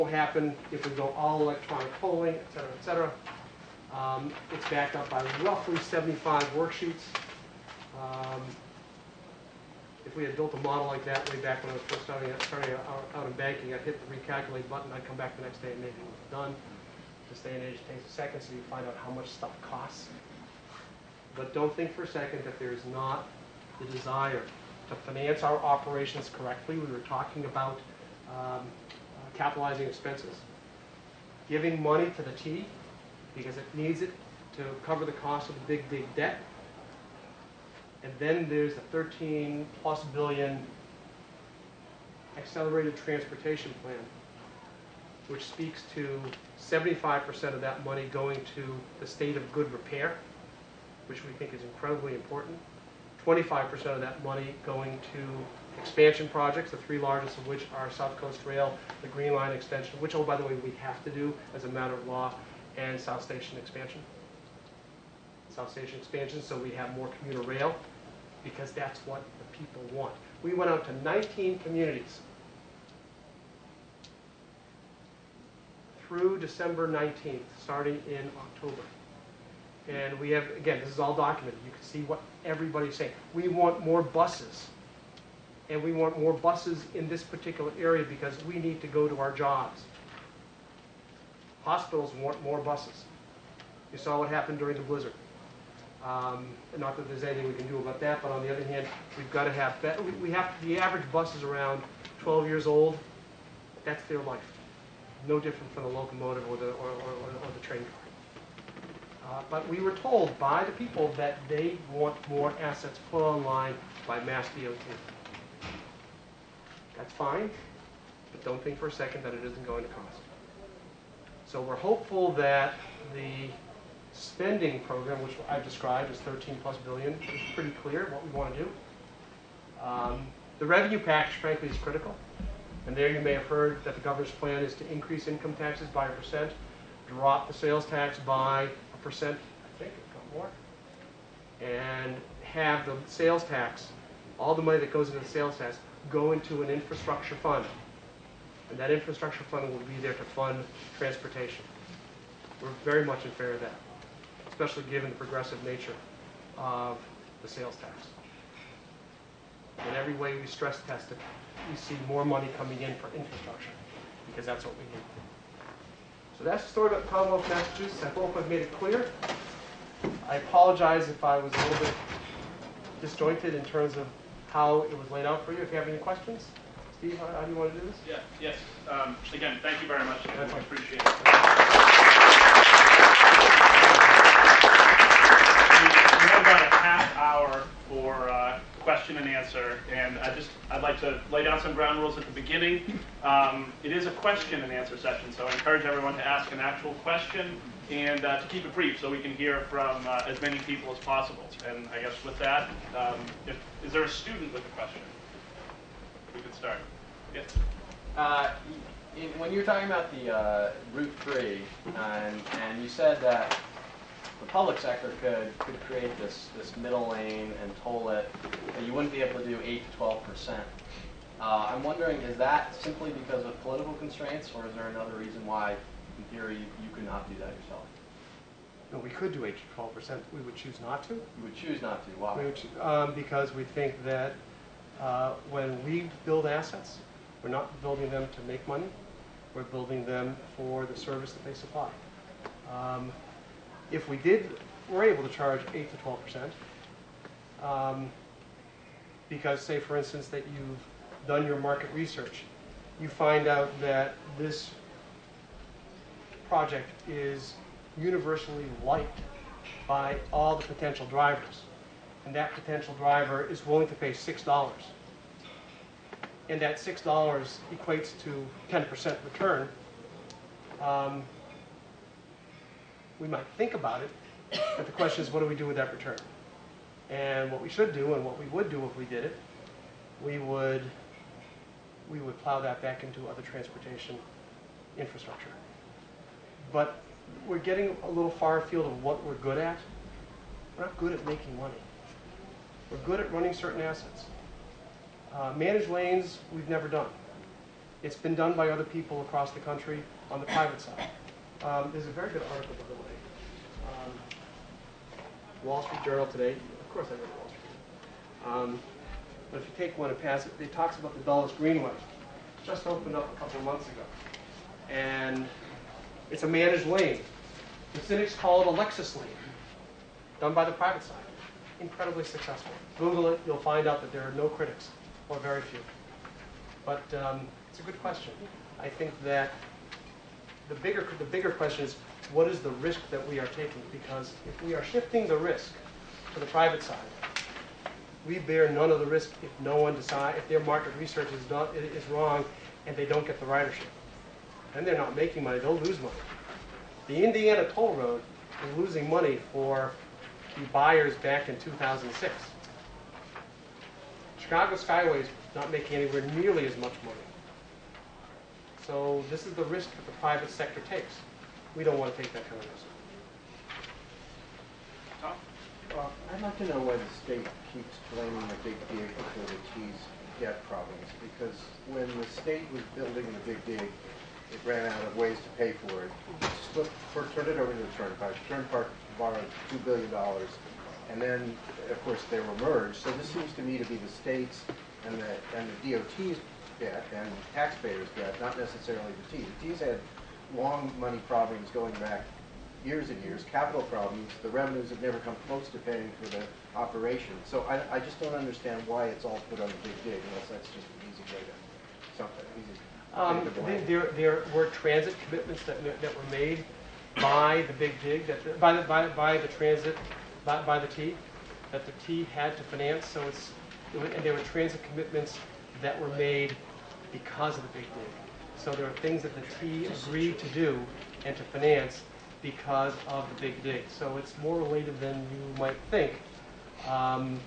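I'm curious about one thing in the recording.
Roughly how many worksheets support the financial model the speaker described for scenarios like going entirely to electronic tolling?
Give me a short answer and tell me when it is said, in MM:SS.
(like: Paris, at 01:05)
75, at 00:05.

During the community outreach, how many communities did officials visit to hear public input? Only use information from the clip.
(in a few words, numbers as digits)
19.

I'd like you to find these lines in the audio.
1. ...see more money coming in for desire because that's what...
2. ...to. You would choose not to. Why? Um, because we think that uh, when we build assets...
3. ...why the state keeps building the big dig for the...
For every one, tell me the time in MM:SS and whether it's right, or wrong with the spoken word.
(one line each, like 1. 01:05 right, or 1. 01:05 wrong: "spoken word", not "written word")
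1. 02:41 wrong: "infrastructure", not "desire"
2. 03:51 right
3. 06:06 wrong: "blaming", not "building".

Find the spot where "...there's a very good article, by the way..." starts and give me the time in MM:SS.
05:01.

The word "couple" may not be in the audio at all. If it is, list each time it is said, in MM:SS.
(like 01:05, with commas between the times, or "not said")
02:20, 05:13.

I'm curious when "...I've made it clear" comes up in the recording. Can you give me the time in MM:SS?
02:48.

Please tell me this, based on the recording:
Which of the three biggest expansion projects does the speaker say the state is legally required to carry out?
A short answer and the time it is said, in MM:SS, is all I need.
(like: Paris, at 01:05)
Green Line extension, at 00:59.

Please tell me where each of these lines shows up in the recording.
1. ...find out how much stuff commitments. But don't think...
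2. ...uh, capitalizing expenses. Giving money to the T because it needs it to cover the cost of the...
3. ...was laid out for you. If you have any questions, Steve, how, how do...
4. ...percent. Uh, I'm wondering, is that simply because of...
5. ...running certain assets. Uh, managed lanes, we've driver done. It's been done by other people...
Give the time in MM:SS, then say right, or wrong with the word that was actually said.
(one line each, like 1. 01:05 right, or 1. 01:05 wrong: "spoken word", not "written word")
1. 00:18 wrong: "costs", not "commitments"
2. 00:28 right
3. 02:54 right
4. 03:40 right
5. 04:53 wrong: "never", not "driver".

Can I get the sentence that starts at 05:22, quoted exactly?
Google it, you'll find out that there are no critics, or very few.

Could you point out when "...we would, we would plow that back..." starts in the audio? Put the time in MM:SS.
04:40.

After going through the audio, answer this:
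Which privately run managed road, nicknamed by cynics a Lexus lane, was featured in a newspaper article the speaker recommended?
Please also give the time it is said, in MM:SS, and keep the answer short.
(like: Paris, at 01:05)
Dulles Greenway, at 05:11.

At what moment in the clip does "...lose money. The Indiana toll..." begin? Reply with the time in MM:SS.
05:45.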